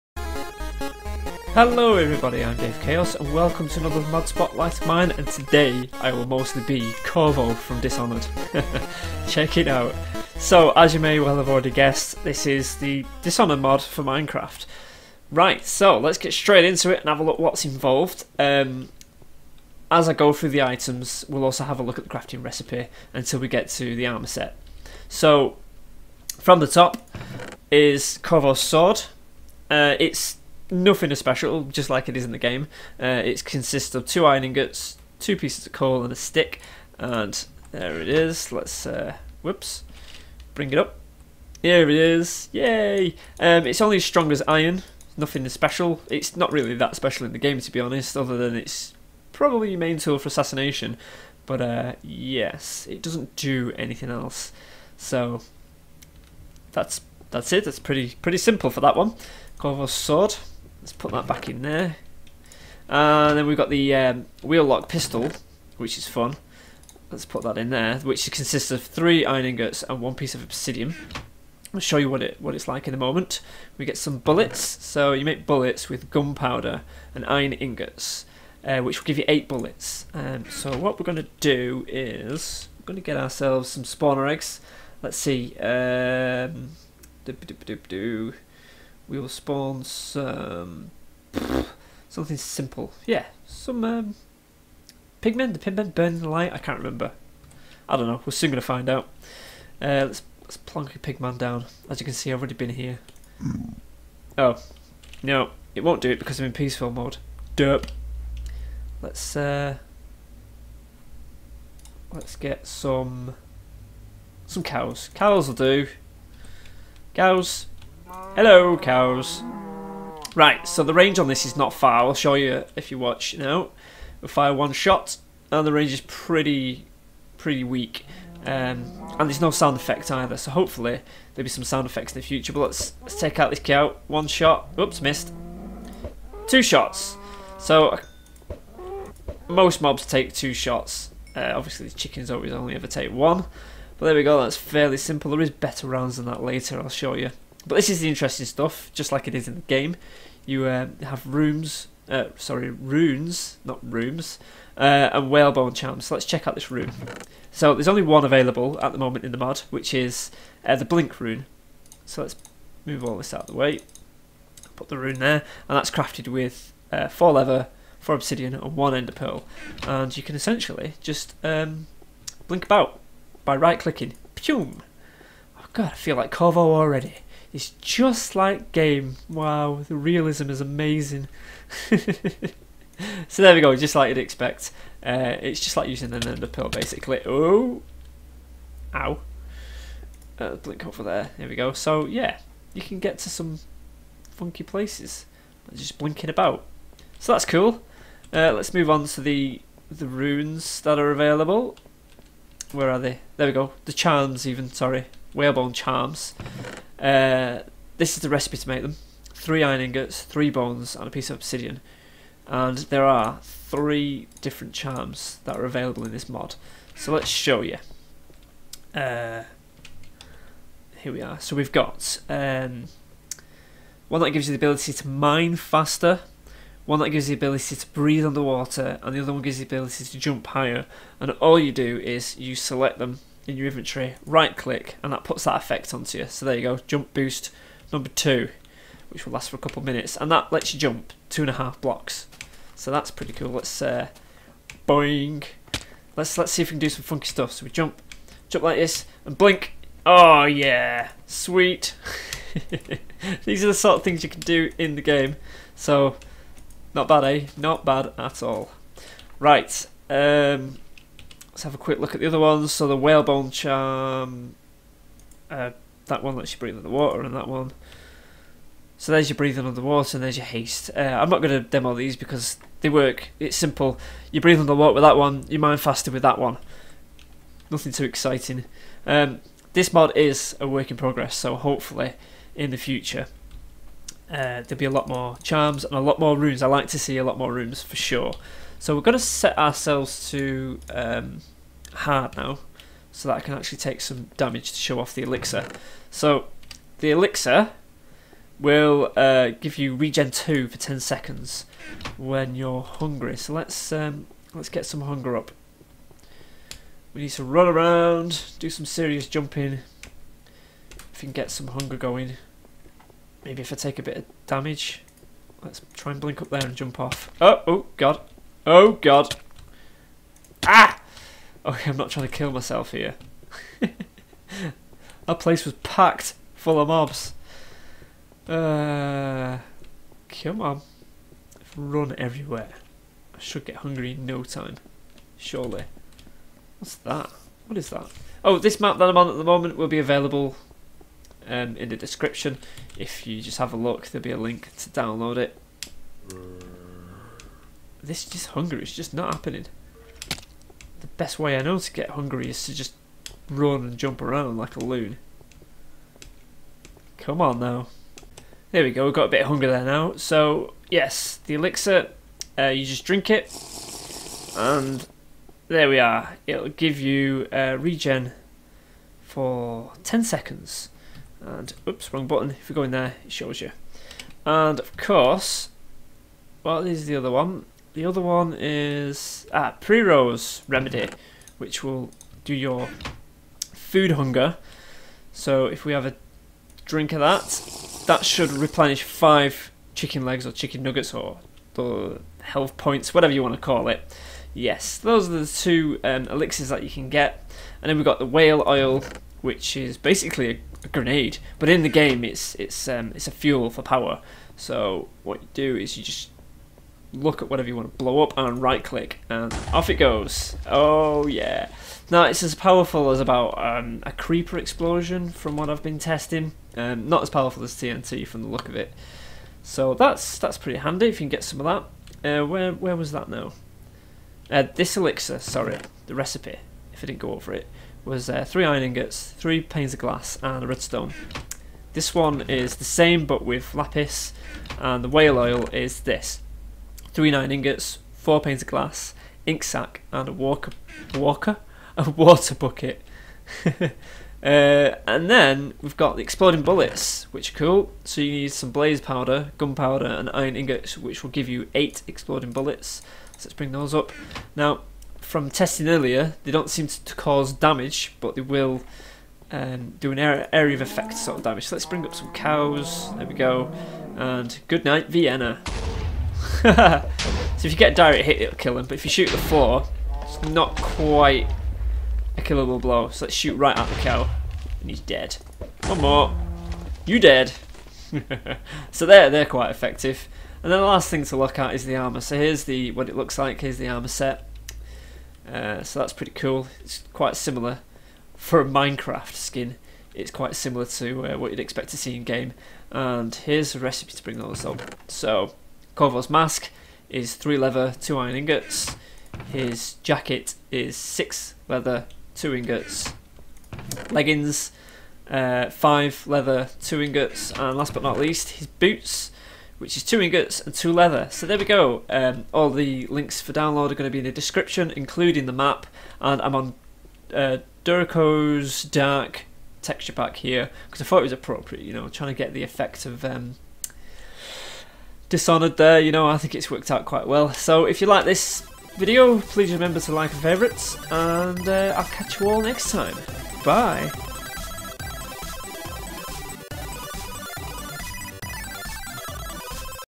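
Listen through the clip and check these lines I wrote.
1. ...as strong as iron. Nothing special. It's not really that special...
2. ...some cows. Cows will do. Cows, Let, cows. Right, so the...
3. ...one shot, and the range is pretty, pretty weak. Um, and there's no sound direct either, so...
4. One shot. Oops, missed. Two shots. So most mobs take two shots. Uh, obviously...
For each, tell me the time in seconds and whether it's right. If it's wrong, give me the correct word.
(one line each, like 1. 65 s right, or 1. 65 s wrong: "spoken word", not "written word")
1. 43 s right
2. 114 s wrong: "Hello", not "Let"
3. 124 s wrong: "effect", not "direct"
4. 134 s right.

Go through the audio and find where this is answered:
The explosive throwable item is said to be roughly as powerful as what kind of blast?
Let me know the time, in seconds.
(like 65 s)
414 s.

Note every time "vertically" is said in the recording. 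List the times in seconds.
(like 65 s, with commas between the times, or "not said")
not said.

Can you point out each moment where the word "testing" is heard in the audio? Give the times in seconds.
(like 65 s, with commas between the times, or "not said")
415 s, 455 s.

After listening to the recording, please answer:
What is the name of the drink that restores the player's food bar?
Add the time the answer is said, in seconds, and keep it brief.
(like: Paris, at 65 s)
Piero's Remedy, at 379 s.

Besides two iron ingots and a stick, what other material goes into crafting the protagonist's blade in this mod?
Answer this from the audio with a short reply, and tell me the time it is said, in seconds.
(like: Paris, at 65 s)
Coal, at 35 s.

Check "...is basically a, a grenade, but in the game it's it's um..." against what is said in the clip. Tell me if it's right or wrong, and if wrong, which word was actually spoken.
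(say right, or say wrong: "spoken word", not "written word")
right.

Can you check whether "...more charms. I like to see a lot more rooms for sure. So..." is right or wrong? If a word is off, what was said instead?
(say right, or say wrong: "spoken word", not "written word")
wrong: "rooms", not "charms".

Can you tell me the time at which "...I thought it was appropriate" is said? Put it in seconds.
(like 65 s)
521 s.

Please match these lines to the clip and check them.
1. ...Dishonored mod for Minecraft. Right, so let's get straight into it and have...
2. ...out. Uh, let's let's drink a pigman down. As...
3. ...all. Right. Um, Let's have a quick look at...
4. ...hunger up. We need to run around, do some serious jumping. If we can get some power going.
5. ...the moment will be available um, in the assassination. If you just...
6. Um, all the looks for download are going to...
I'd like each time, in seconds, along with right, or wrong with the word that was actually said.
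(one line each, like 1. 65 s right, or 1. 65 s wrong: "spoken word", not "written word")
1. 13 s right
2. 98 s wrong: "plonk", not "drink"
3. 258 s right
4. 305 s wrong: "hunger", not "power"
5. 339 s wrong: "description", not "assassination"
6. 512 s wrong: "links", not "looks".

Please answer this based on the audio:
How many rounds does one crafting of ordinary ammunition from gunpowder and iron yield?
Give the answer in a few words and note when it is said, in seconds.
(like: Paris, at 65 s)
8, at 79 s.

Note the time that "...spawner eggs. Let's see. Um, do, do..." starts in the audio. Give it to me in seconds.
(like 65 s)
83 s.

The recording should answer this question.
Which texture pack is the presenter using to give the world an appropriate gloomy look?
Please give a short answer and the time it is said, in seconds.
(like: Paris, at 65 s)
Durico's Dark, at 517 s.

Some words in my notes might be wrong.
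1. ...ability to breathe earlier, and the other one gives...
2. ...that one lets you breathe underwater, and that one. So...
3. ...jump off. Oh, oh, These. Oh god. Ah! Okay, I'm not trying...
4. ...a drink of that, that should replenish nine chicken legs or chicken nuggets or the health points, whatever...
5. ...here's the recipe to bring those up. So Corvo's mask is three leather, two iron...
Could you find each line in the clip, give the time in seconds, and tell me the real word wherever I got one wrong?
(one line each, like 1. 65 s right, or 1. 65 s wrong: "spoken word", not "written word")
1. 227 s wrong: "underwater", not "earlier"
2. 266 s right
3. 316 s wrong: "God", not "These"
4. 386 s wrong: "five", not "nine"
5. 493 s right.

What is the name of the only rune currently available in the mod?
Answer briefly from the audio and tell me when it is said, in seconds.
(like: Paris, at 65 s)
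Blink rune, at 160 s.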